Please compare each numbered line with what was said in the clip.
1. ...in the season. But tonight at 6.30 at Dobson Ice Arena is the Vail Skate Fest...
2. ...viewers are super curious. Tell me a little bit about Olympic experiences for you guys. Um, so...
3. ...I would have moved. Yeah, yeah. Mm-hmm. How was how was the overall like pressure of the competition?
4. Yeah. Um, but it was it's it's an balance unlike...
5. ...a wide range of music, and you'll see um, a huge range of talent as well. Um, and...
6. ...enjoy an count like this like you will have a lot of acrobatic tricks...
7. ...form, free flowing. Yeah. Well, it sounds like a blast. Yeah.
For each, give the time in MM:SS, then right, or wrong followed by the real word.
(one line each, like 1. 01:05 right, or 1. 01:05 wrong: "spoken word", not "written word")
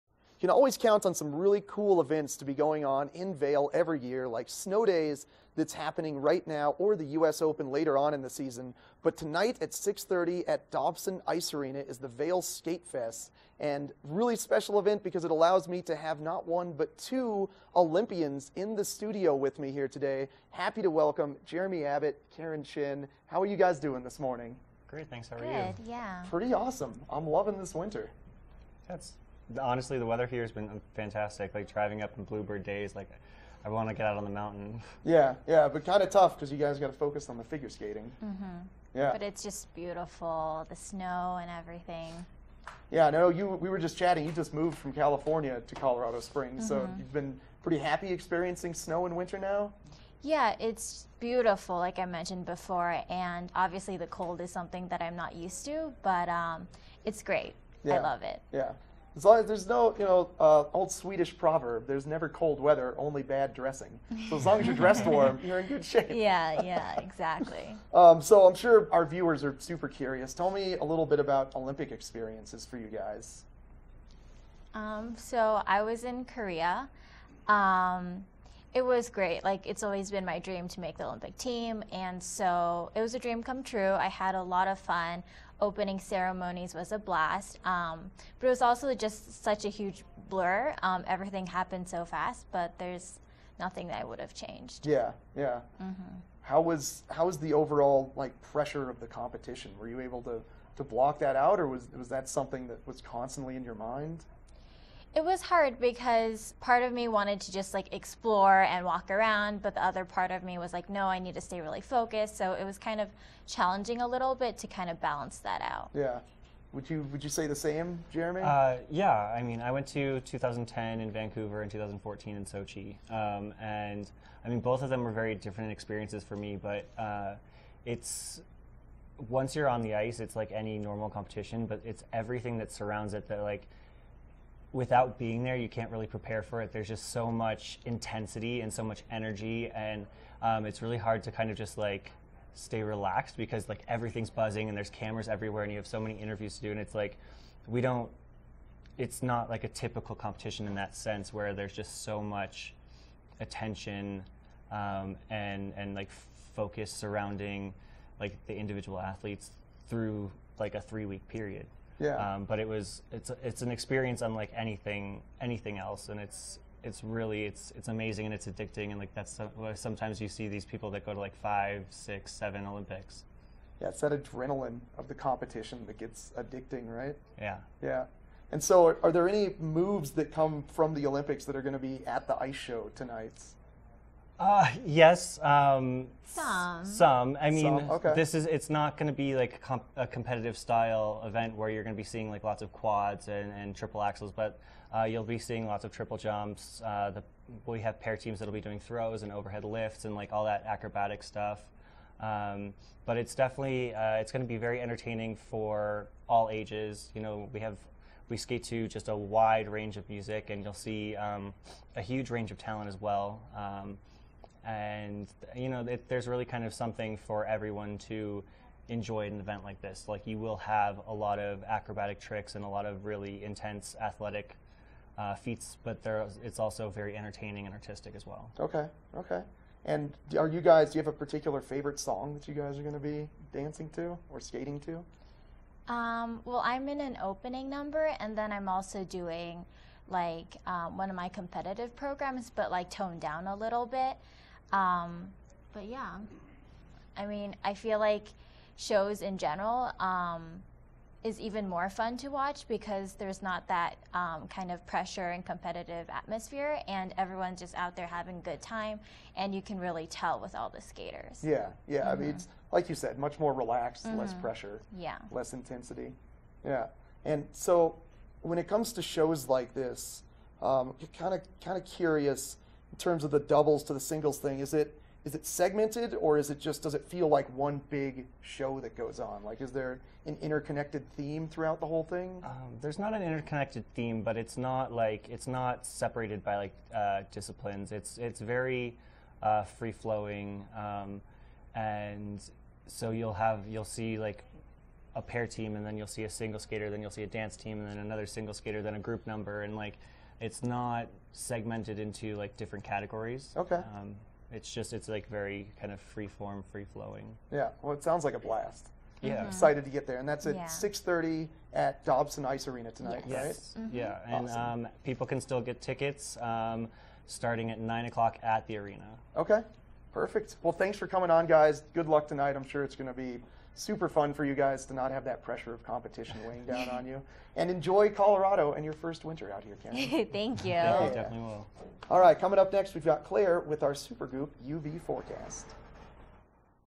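1. 00:08 right
2. 01:09 right
3. 01:34 wrong: "changed", not "moved"
4. 02:42 wrong: "experience", not "balance"
5. 03:29 right
6. 03:38 wrong: "event", not "count"
7. 05:06 right.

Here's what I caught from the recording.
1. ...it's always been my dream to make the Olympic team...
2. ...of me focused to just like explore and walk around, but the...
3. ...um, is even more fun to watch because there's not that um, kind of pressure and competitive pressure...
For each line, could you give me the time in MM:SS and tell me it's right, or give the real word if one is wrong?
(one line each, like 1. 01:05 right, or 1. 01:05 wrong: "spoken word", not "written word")
1. 01:19 right
2. 01:46 wrong: "wanted", not "focused"
3. 04:09 wrong: "atmosphere", not "pressure".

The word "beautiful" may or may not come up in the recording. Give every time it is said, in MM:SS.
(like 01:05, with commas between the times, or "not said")
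00:39, 00:51.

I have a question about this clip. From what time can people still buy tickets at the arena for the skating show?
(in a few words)
9:00.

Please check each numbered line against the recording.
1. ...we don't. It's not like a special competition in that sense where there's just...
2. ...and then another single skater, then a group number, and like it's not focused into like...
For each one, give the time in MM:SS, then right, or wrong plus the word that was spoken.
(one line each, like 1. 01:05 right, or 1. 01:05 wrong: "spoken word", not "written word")
1. 02:27 wrong: "typical", not "special"
2. 04:57 wrong: "segmented", not "focused".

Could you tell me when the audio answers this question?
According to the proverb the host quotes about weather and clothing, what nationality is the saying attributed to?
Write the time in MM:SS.
01:00.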